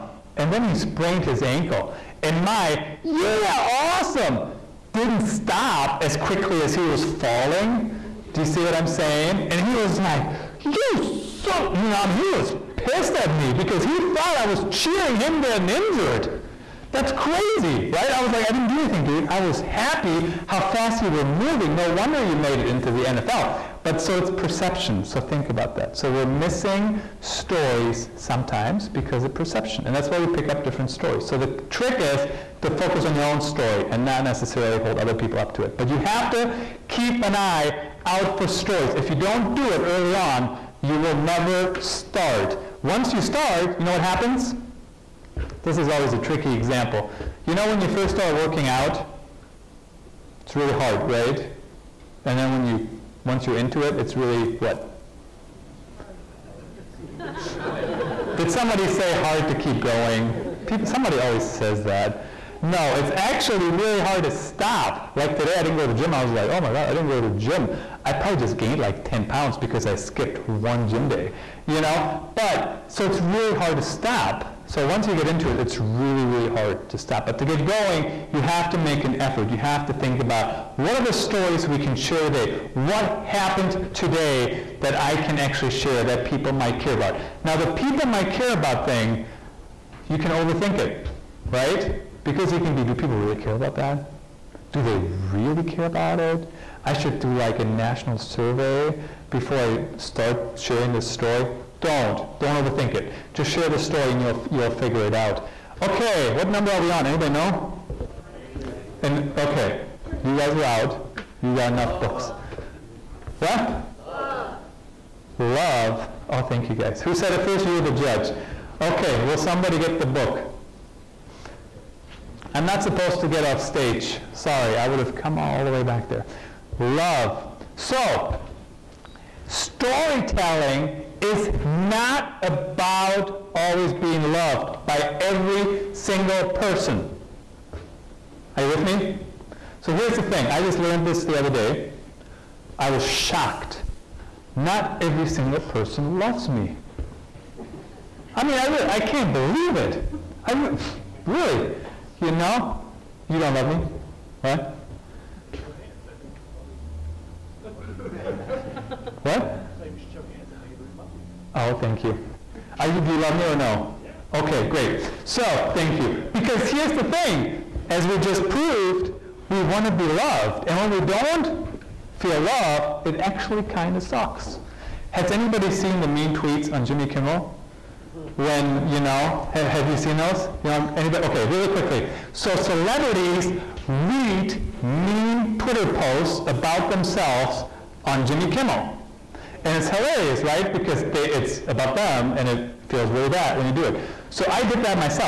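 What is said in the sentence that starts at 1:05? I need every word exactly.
Like today, I didn't go to the gym.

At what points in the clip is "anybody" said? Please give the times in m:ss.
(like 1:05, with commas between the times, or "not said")
1:47, 2:55, 3:00.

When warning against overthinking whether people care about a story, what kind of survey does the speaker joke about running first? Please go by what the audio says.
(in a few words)
national survey.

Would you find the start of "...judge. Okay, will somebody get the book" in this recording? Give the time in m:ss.
1:57.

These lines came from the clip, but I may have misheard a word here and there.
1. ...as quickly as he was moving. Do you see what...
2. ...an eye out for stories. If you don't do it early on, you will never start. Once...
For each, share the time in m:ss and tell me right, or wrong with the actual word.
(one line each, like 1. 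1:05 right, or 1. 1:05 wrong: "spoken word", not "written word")
1. 0:06 wrong: "falling", not "moving"
2. 0:37 right.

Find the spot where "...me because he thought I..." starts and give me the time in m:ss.
0:13.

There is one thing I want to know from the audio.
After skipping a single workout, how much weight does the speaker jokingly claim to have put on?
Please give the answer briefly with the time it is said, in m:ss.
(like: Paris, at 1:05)
10 pounds, at 1:09.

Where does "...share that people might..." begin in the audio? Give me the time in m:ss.
1:25.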